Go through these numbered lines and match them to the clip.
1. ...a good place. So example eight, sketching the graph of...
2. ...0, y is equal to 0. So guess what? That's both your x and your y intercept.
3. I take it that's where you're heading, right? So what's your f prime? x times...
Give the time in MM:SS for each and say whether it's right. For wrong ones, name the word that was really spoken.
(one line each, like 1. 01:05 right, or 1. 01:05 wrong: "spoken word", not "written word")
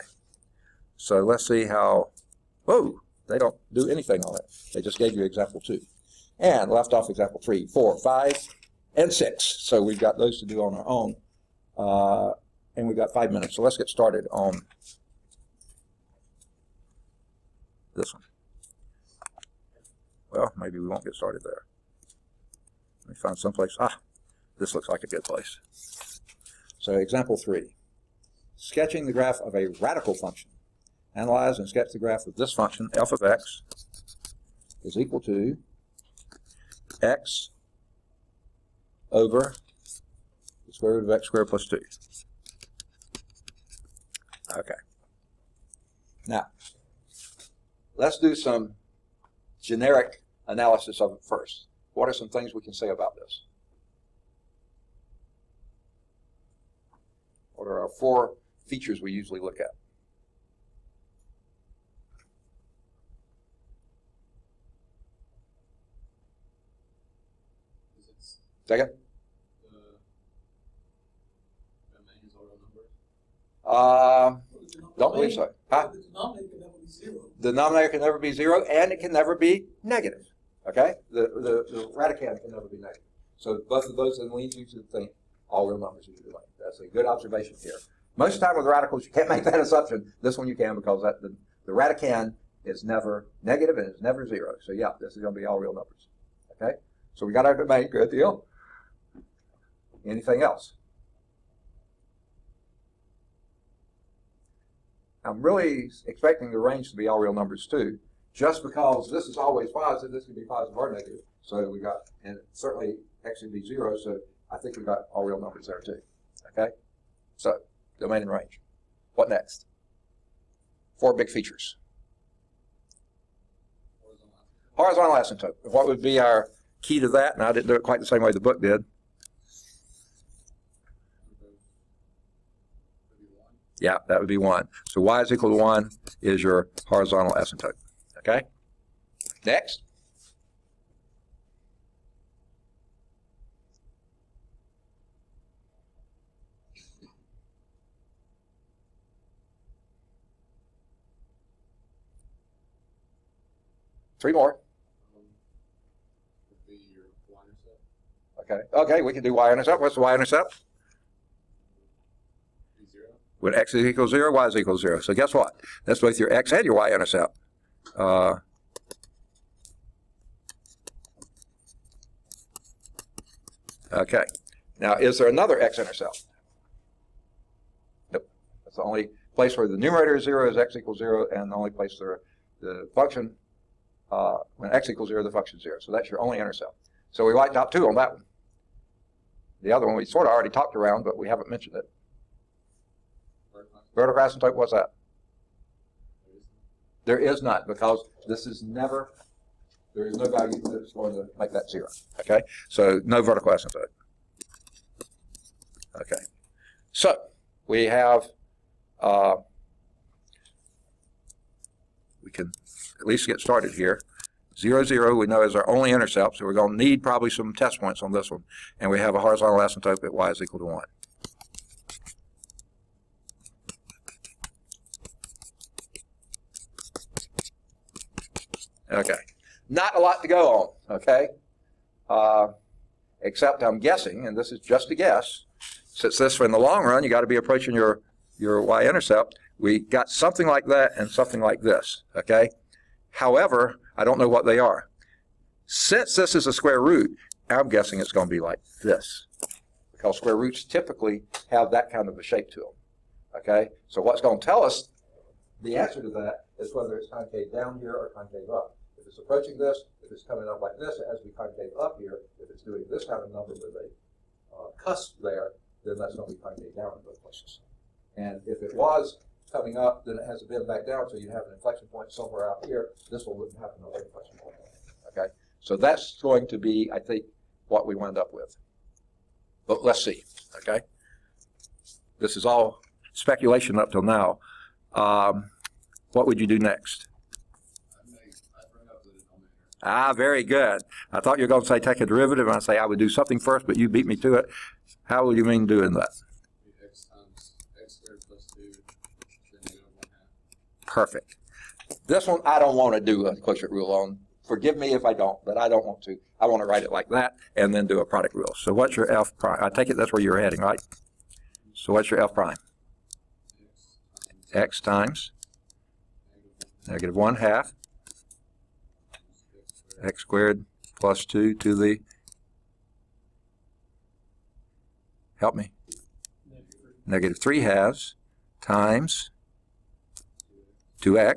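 1. 00:25 wrong: "three", not "eight"
2. 02:44 right
3. 05:09 right.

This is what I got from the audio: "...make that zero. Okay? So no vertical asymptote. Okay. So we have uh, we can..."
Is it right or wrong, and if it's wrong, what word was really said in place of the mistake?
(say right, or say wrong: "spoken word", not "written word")
right.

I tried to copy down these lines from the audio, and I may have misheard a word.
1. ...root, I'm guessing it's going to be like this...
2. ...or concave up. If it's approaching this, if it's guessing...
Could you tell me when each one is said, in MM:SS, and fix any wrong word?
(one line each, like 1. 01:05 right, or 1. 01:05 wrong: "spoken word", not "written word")
1. 04:06 right
2. 04:17 wrong: "coming", not "guessing".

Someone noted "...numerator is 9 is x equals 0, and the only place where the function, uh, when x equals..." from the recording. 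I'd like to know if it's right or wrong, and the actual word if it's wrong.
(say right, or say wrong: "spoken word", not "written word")
wrong: "0", not "9".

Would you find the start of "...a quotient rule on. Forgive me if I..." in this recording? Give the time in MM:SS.
05:03.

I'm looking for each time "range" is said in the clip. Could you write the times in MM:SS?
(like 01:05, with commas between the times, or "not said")
01:46, 01:58.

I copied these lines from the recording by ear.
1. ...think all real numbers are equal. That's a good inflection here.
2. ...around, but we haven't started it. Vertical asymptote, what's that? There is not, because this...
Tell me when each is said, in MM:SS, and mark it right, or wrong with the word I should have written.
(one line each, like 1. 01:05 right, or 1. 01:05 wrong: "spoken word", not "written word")
1. 01:24 wrong: "observation", not "inflection"
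2. 03:10 wrong: "mentioned", not "started".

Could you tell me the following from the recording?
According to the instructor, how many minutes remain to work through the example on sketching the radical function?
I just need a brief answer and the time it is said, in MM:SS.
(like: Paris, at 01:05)
5, at 00:13.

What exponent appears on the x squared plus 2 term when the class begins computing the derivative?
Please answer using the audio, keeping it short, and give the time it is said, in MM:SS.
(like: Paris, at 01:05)
-3/2, at 05:27.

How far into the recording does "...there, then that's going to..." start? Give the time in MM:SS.
04:25.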